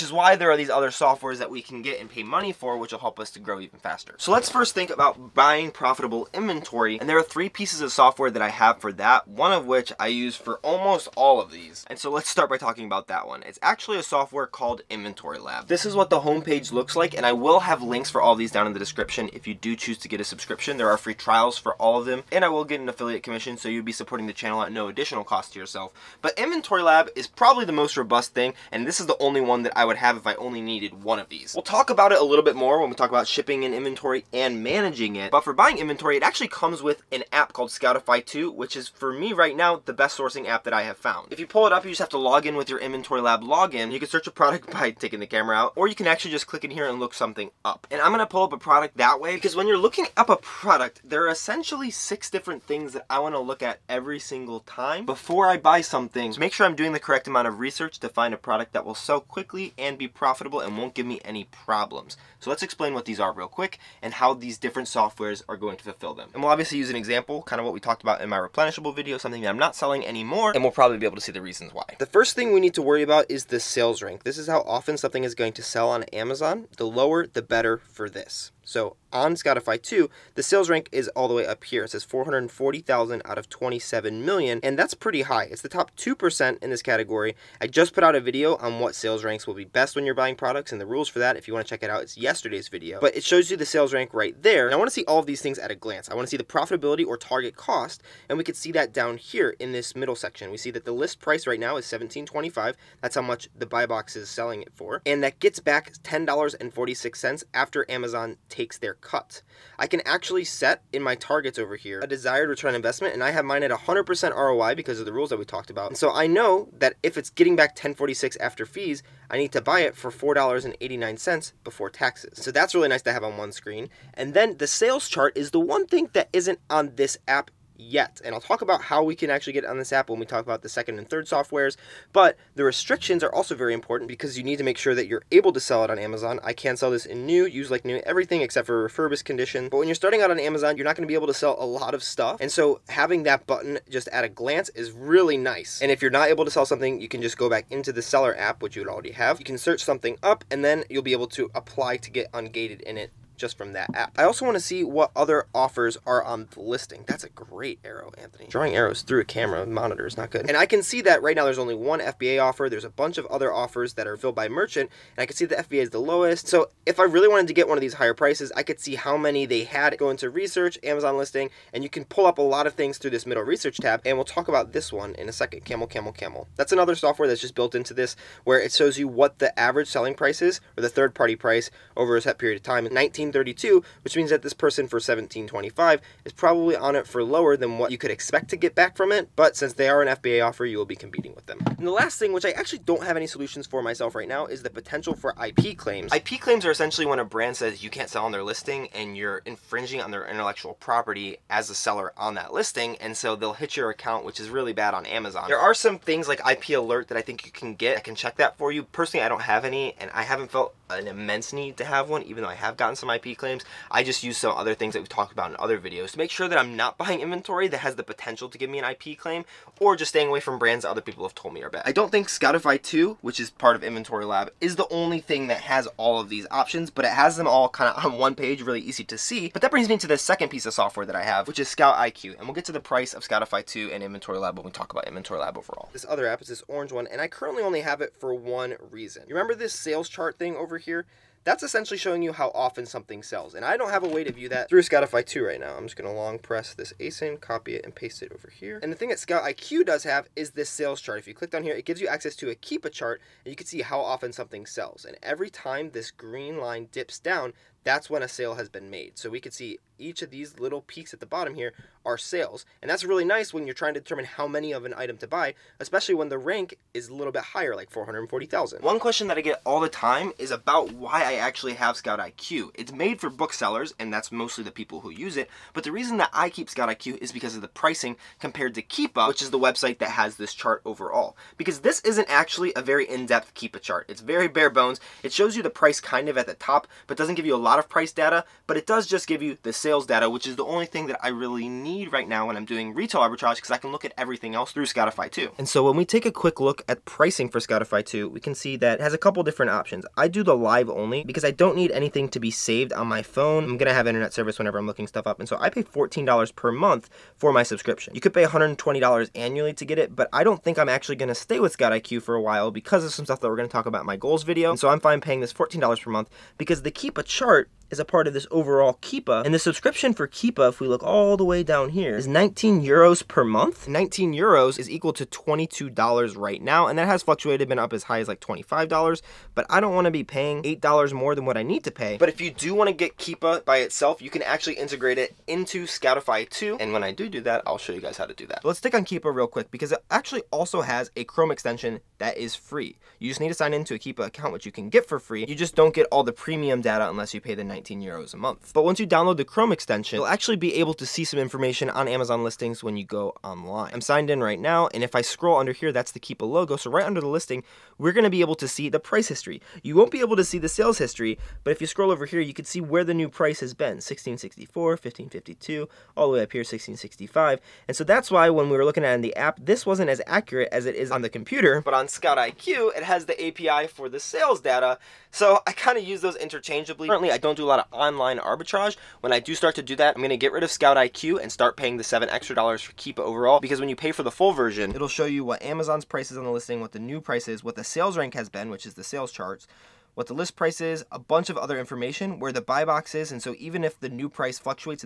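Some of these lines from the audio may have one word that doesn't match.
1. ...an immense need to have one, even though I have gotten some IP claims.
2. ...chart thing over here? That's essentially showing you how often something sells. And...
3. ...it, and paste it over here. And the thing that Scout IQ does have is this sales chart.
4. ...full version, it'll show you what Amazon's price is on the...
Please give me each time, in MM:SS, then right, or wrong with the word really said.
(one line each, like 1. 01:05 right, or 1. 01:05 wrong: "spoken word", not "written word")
1. 03:30 right
2. 04:00 right
3. 04:07 right
4. 06:24 right.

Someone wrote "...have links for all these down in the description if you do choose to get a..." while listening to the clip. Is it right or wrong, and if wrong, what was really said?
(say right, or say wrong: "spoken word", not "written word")
right.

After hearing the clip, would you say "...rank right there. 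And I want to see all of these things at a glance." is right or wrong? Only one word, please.
right.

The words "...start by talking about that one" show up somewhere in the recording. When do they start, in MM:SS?
00:12.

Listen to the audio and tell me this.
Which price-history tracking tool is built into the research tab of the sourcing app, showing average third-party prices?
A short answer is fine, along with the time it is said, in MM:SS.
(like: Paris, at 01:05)
Camel Camel Camel, at 02:55.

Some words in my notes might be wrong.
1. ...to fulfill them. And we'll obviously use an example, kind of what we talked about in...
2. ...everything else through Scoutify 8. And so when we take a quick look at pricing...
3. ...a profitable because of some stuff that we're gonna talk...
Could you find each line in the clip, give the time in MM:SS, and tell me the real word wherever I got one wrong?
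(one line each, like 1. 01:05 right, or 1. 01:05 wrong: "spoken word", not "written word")
1. 01:05 right
2. 04:54 wrong: "2", not "8"
3. 05:12 wrong: "while", not "profitable".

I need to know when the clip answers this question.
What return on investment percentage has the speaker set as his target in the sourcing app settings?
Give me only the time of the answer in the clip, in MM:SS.
01:53.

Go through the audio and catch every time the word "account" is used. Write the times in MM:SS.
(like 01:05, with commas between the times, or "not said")
03:23, 05:44.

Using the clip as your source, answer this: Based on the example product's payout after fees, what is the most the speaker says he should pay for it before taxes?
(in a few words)
$4.89.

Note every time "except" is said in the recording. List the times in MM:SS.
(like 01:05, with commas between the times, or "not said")
02:18.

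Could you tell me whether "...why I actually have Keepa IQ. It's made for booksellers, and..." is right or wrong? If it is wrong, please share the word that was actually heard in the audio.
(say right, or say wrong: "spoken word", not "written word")
wrong: "Scout", not "Keepa".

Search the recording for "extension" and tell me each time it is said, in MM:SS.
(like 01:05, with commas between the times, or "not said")
05:41, 05:49.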